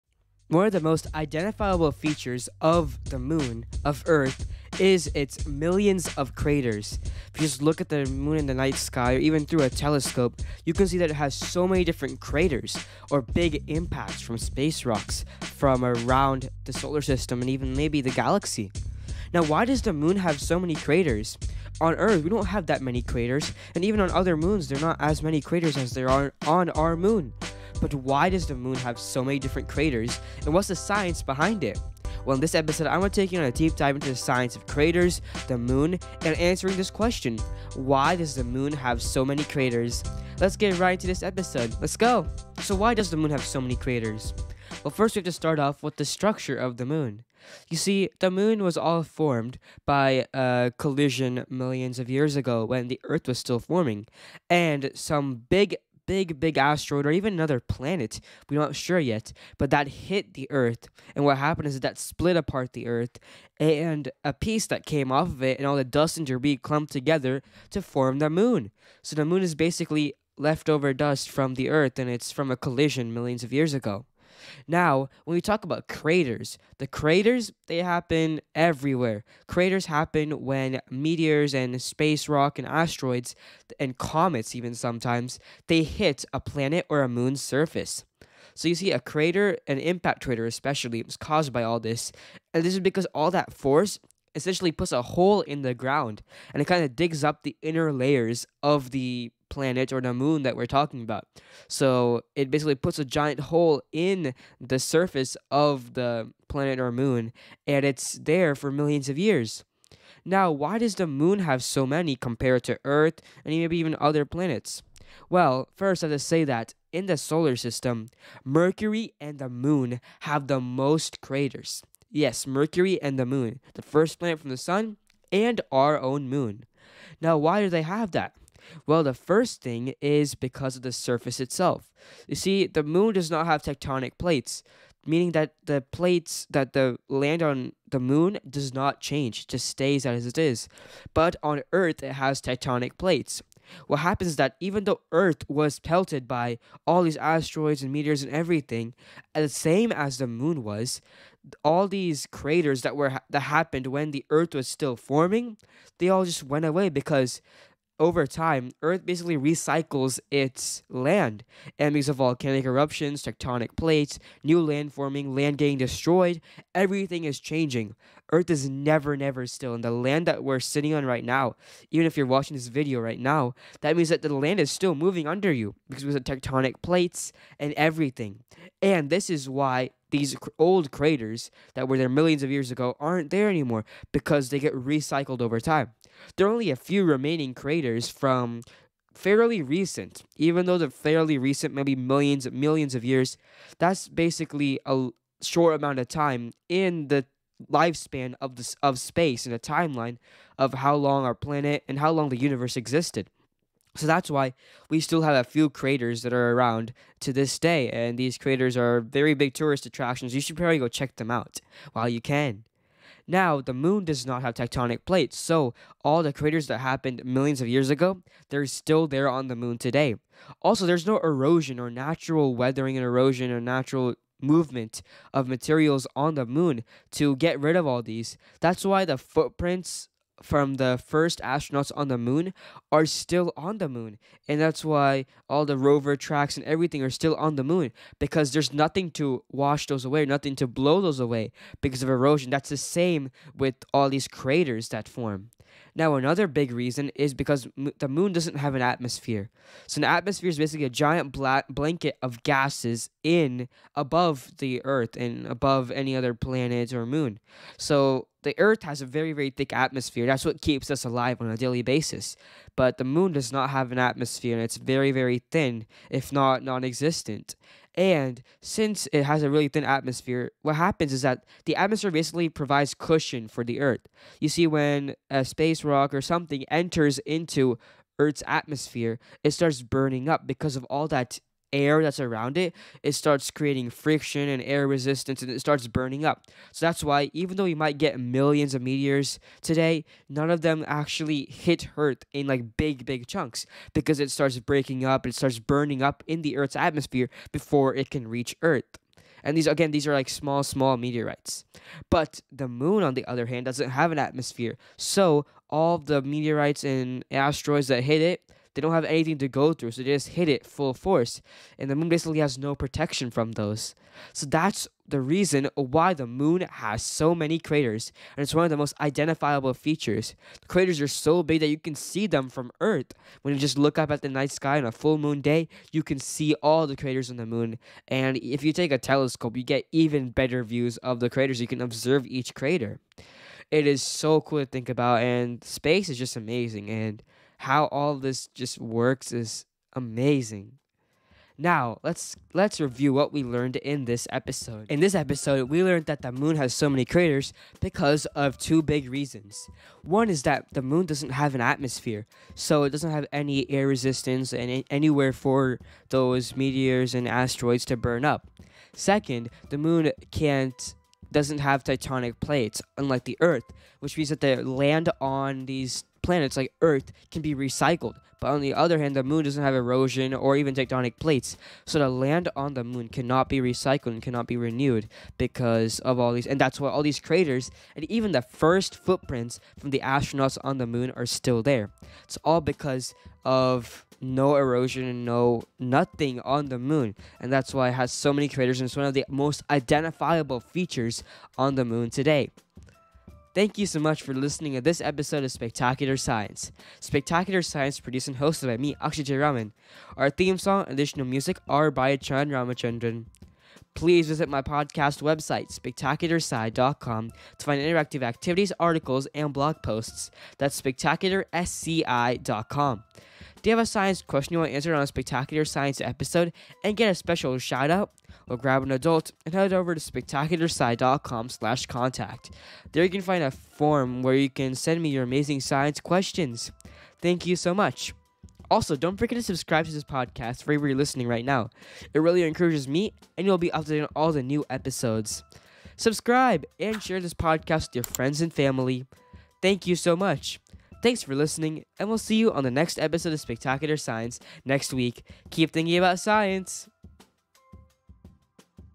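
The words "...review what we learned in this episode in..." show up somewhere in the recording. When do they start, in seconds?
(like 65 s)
342 s.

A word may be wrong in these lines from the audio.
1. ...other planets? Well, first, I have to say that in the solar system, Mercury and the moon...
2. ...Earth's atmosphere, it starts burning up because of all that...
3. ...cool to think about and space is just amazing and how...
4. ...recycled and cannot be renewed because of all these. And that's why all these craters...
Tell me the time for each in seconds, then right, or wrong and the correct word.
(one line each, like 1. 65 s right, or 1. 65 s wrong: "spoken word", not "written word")
1. 113 s right
2. 278 s right
3. 334 s right
4. 373 s right.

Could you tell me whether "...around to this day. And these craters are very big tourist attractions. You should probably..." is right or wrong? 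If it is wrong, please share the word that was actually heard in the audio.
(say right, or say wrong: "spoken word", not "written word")
right.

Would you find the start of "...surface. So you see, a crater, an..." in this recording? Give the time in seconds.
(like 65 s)
87 s.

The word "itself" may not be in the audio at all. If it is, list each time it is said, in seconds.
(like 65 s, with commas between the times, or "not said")
131 s.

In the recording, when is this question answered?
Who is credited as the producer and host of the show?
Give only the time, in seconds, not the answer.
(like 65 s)
399 s.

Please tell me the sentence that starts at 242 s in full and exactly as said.
That's the same with all these craters that form.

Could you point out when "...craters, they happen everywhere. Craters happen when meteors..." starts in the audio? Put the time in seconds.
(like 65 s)
76 s.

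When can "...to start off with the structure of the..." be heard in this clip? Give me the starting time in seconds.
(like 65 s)
45 s.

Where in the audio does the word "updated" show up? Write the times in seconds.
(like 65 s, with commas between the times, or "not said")
433 s.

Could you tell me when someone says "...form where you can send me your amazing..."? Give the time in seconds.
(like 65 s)
423 s.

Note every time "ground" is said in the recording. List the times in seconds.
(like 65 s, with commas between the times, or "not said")
95 s.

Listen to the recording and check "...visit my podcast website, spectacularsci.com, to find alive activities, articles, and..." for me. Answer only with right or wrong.
wrong.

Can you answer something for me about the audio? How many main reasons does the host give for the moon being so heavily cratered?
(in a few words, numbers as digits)
2.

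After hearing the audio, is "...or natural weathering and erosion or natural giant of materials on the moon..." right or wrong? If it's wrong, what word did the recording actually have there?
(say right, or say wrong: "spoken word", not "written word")
wrong: "movement", not "giant".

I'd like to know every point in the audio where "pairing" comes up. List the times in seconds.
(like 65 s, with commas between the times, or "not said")
not said.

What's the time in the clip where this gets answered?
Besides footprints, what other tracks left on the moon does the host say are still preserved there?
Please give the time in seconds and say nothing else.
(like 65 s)
235 s.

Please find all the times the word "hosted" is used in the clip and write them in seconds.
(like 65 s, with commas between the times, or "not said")
398 s.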